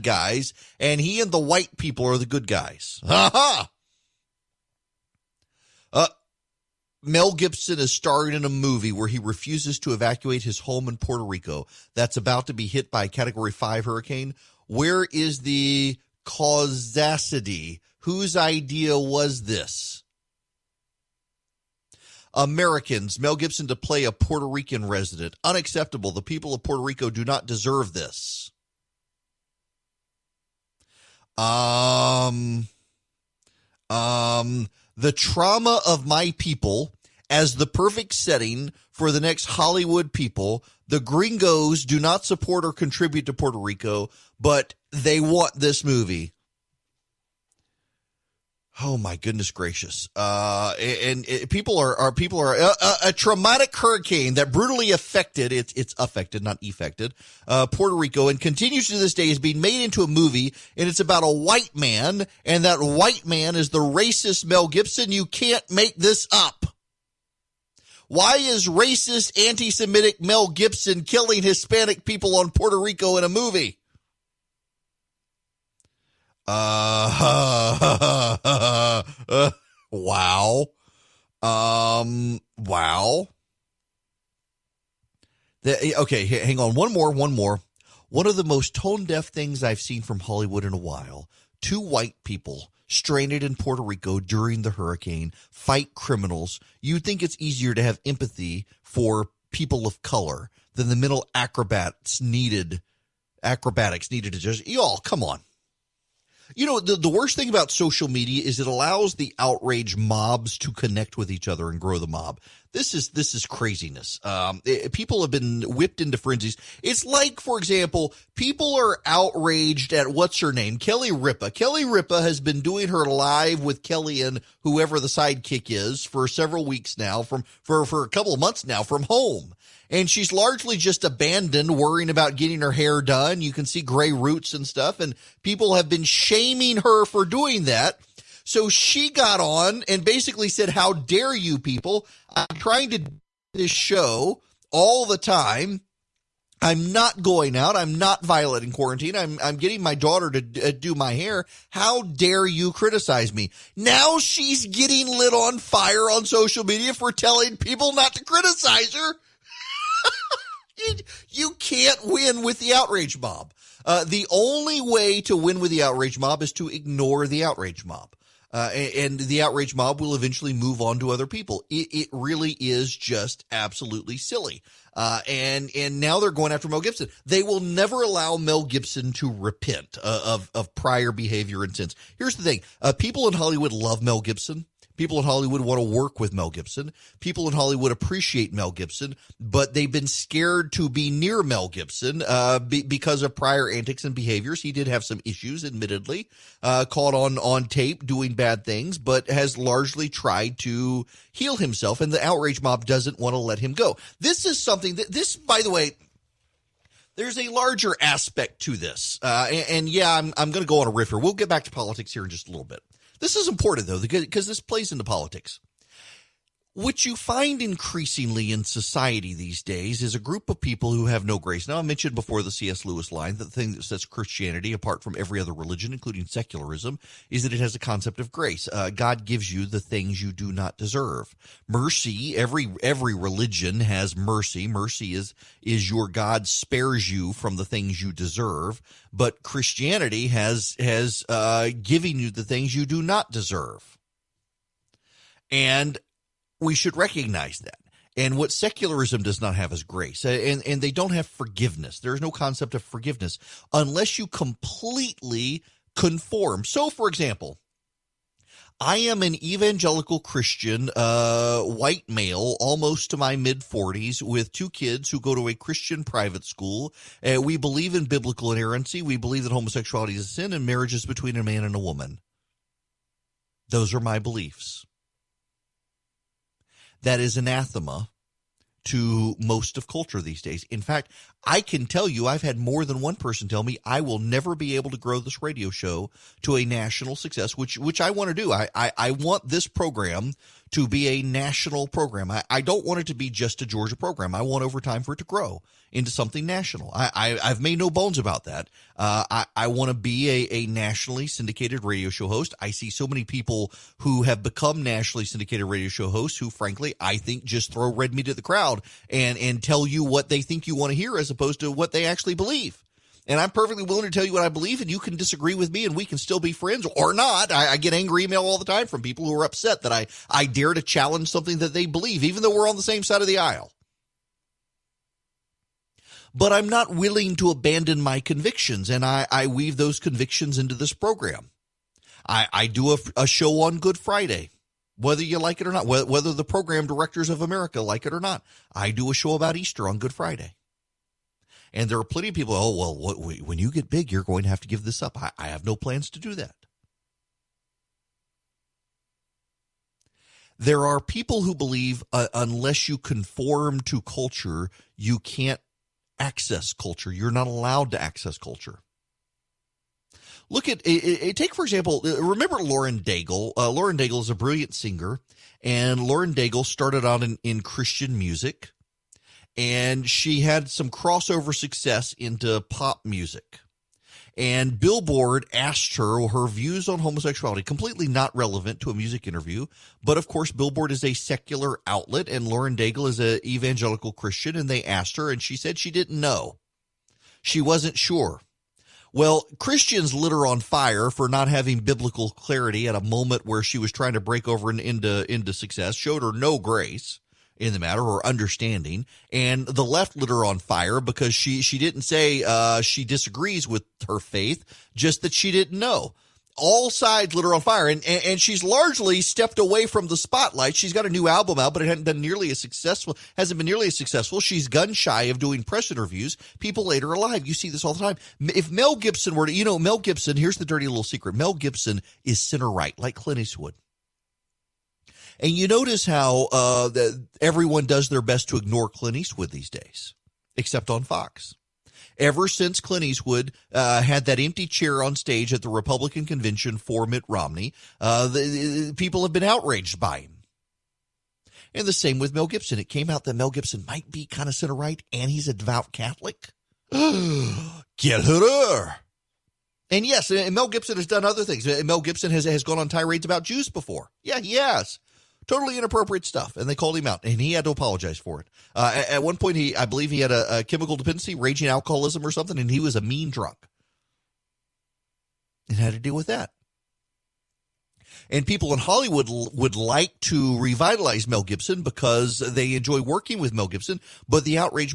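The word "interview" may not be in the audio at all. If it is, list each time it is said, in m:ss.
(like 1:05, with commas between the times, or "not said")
6:19, 6:55.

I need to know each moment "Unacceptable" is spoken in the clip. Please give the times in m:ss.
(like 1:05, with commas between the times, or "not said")
0:25.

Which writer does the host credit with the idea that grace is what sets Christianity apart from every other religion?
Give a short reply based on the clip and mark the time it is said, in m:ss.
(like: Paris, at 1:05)
C.S. Lewis, at 3:42.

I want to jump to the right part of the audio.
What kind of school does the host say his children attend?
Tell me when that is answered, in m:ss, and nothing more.
4:25.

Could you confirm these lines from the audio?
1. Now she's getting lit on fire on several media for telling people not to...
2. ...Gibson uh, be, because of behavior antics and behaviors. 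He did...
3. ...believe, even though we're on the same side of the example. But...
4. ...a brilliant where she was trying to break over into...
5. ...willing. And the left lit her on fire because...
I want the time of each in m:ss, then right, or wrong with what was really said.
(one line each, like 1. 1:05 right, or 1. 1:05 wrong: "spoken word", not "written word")
1. 2:33 wrong: "social", not "several"
2. 3:11 wrong: "prior", not "behavior"
3. 5:21 wrong: "aisle", not "example"
4. 6:32 wrong: "moment", not "brilliant"
5. 6:38 wrong: "understanding", not "willing".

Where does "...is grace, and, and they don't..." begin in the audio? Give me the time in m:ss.
4:09.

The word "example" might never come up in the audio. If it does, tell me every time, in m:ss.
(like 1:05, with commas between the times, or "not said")
1:57, 4:17, 6:01.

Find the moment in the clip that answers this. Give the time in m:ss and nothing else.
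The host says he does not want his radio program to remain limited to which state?
4:53.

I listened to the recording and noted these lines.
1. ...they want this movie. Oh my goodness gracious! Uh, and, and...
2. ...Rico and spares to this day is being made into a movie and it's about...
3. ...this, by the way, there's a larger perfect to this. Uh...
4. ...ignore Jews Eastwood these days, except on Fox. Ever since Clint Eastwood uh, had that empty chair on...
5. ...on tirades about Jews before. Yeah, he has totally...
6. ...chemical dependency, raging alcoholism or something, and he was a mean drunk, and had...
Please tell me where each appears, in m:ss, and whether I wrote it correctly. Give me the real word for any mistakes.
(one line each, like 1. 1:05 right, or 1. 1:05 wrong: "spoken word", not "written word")
1. 0:44 right
2. 0:57 wrong: "continues", not "spares"
3. 3:25 wrong: "aspect", not "perfect"
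4. 7:08 wrong: "Clint", not "Jews"
5. 7:32 right
6. 7:40 right.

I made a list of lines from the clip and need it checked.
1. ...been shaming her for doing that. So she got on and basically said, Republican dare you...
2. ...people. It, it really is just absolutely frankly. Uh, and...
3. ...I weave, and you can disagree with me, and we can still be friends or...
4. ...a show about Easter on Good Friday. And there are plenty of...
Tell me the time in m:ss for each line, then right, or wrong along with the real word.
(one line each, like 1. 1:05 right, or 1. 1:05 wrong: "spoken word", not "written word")
1. 2:15 wrong: "How", not "Republican"
2. 2:51 wrong: "silly", not "frankly"
3. 5:14 wrong: "believe", not "weave"
4. 5:39 right.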